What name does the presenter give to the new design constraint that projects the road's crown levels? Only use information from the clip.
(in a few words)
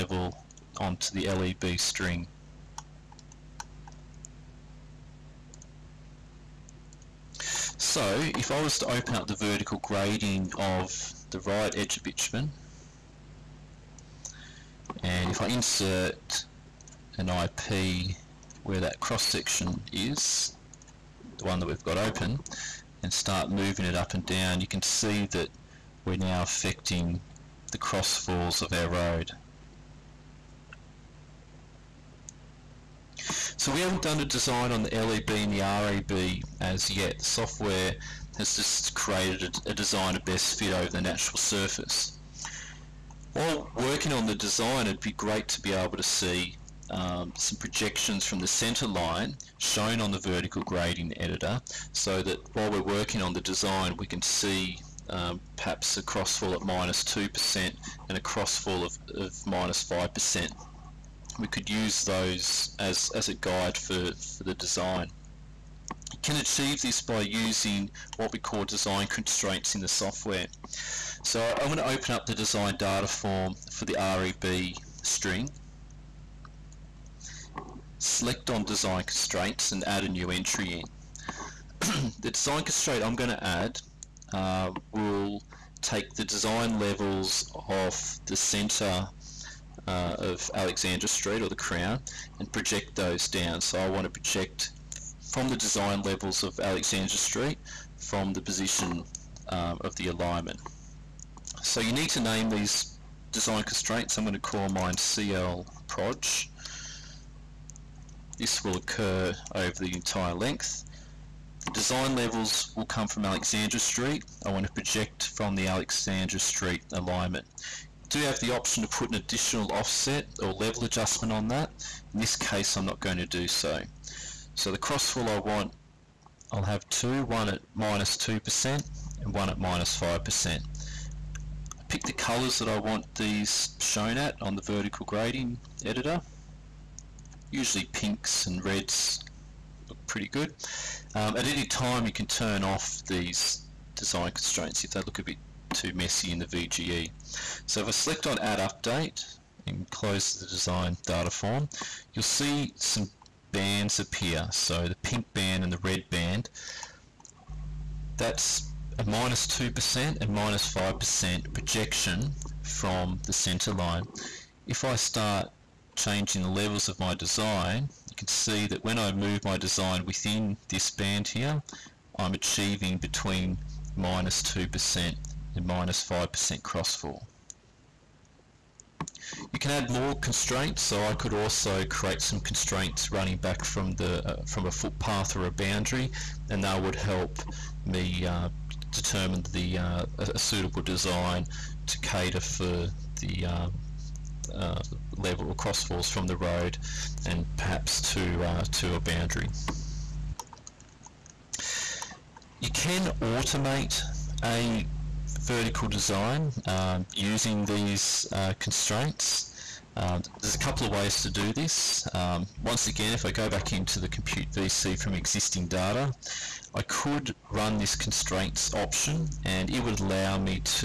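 CL proj.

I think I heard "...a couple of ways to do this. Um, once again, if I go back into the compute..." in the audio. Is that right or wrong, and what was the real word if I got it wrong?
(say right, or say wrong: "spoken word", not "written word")
right.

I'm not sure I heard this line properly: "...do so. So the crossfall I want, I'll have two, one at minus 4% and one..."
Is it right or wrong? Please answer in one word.
wrong.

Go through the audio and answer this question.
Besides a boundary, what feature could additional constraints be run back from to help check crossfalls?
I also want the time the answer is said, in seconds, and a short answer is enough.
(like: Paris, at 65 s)
A footpath, at 184 s.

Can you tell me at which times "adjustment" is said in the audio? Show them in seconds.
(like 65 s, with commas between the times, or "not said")
120 s.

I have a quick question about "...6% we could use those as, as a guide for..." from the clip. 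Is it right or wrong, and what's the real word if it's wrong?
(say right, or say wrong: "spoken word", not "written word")
wrong: "5", not "6".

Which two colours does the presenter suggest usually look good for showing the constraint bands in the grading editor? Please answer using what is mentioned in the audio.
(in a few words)
Pinks and reds.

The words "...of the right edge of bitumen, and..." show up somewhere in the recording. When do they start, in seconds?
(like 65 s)
10 s.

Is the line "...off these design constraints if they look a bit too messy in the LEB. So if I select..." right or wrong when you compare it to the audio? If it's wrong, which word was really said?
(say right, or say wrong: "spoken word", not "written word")
wrong: "VGE", not "LEB".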